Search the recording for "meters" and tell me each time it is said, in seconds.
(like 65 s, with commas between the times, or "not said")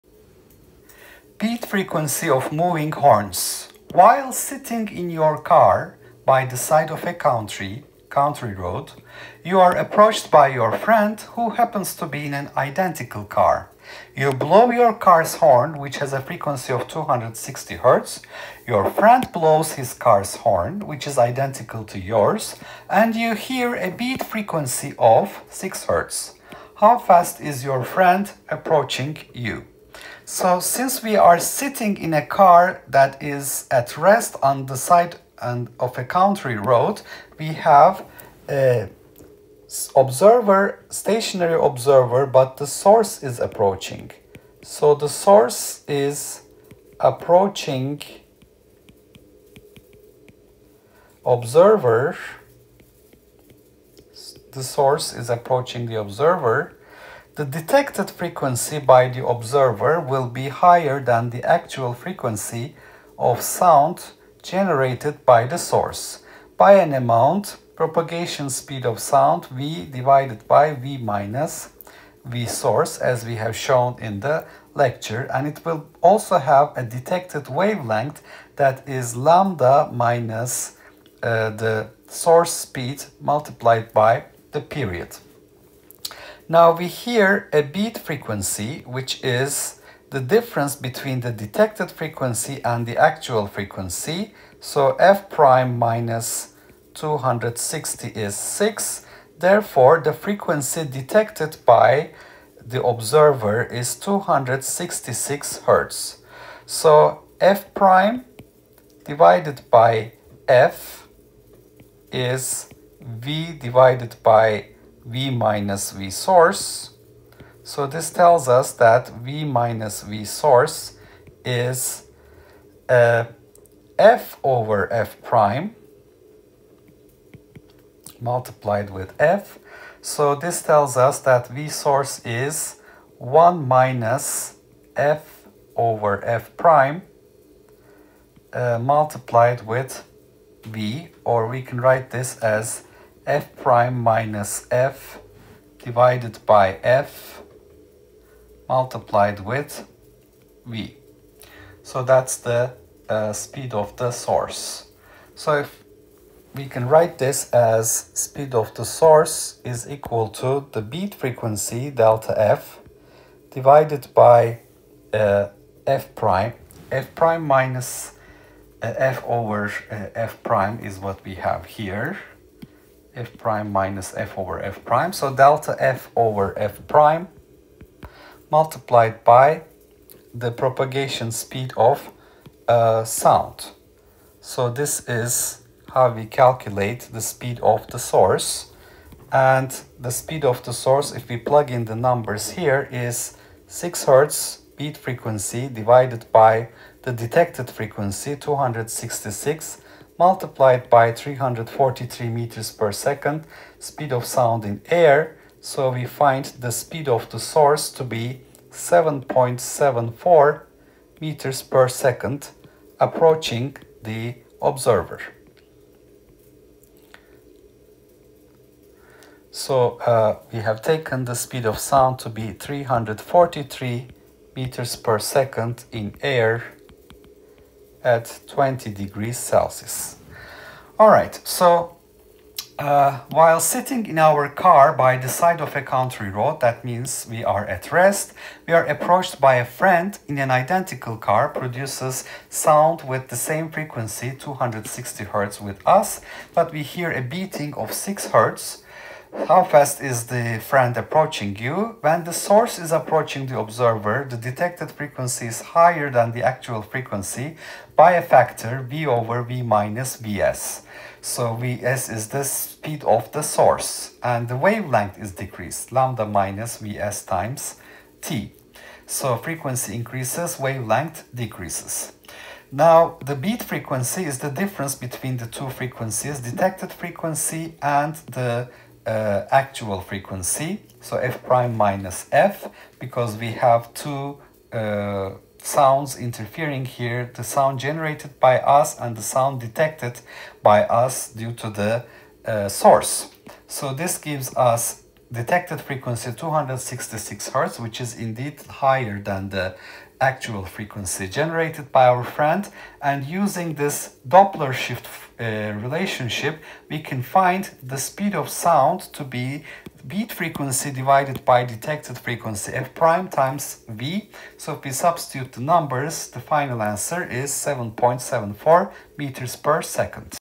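202 s, 211 s, 224 s, 319 s.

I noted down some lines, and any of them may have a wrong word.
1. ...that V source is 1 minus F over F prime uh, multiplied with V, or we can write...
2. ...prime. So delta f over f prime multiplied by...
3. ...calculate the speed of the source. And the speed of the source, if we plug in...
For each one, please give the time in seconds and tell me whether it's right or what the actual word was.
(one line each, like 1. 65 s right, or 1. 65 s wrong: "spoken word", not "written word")
1. 131 s right
2. 174 s right
3. 186 s right.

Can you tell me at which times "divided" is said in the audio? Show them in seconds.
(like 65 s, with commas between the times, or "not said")
69 s, 109 s, 113 s, 145 s, 163 s, 195 s, 310 s.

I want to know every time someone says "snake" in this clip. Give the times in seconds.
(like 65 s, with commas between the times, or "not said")
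not said.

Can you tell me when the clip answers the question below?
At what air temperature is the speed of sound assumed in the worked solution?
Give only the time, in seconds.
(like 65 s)
228 s.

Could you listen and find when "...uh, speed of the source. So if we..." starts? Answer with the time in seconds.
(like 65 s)
153 s.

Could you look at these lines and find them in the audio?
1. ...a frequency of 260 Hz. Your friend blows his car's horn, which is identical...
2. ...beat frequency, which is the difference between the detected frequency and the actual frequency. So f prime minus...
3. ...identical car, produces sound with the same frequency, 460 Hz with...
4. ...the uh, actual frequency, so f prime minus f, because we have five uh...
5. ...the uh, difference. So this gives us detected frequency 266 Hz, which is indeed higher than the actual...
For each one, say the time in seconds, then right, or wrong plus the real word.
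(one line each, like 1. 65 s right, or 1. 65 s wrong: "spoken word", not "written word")
1. 16 s right
2. 87 s right
3. 240 s wrong: "260", not "460"
4. 278 s wrong: "two", not "five"
5. 291 s wrong: "source", not "difference".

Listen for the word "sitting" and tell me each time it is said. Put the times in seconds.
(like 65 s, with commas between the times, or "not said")
4 s, 31 s, 233 s.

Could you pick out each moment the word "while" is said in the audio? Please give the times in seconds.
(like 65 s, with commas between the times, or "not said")
3 s, 233 s.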